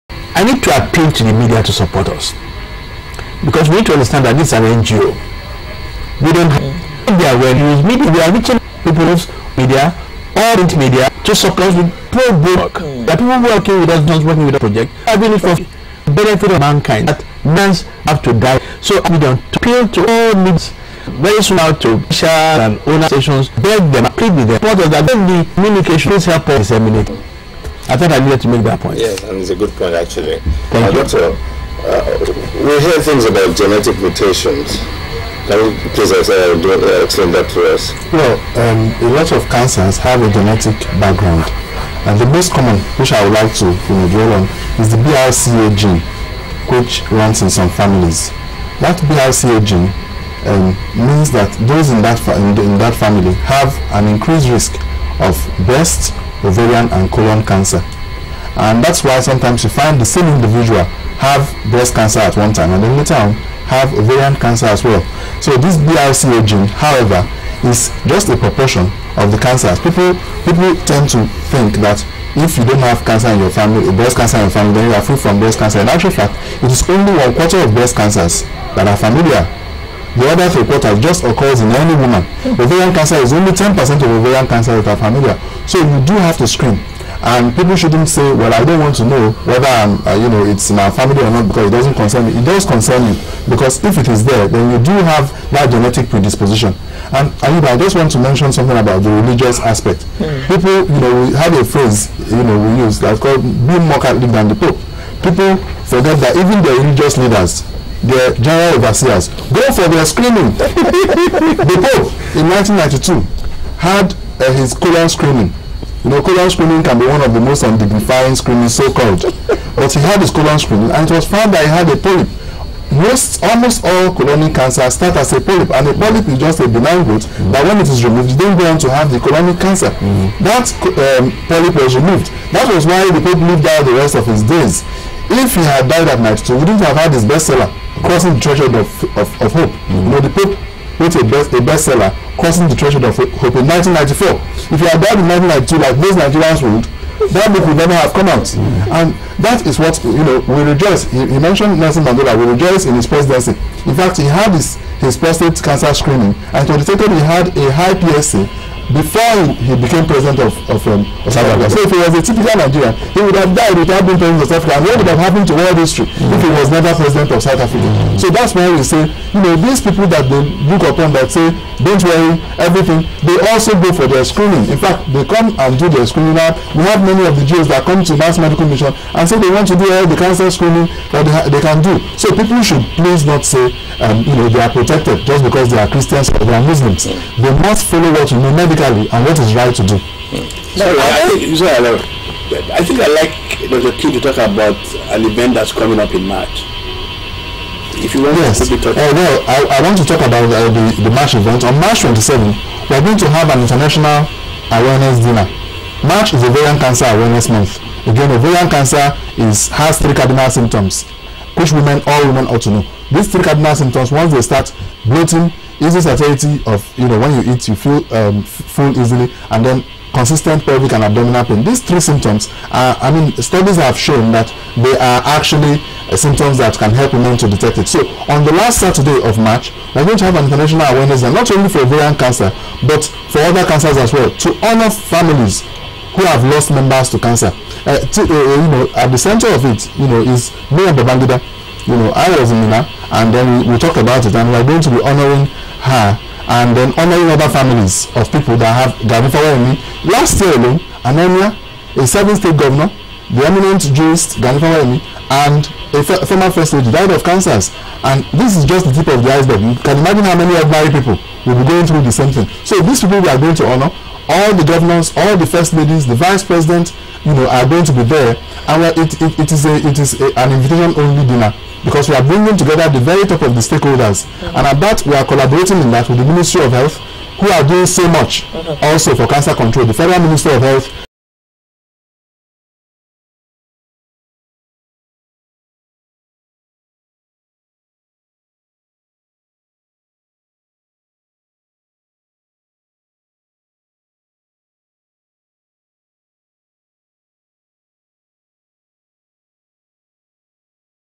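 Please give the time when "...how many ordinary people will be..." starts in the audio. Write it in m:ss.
4:20.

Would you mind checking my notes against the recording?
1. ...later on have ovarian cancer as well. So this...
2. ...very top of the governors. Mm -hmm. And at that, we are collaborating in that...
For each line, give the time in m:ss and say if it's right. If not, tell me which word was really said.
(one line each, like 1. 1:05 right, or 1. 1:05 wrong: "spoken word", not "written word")
1. 1:02 right
2. 4:32 wrong: "stakeholders", not "governors".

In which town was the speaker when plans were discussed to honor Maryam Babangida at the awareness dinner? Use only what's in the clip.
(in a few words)
Minna.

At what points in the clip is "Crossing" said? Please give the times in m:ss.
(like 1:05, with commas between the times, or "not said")
2:18, 2:22.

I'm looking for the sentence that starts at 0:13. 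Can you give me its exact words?
that The people working with us, not working with the project, believe it for benefit of mankind.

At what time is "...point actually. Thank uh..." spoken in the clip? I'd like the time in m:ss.
0:29.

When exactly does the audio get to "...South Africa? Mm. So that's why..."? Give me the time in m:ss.
2:47.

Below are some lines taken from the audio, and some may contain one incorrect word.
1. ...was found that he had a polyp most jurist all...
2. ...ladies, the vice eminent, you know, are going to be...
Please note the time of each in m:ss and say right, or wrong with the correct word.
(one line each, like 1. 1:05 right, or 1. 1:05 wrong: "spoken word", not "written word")
1. 2:01 wrong: "almost", not "jurist"
2. 4:25 wrong: "president", not "eminent".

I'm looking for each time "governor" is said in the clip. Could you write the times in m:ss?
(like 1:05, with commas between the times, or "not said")
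4:12, 4:24.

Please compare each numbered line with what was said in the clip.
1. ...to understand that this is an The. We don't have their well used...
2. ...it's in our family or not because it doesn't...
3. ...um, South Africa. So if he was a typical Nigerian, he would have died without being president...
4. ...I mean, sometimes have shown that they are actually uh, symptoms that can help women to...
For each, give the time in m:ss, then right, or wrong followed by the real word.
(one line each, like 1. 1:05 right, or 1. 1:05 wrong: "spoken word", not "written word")
1. 0:03 wrong: "NGO", not "The"
2. 1:30 right
3. 2:40 right
4. 3:42 wrong: "studies", not "sometimes".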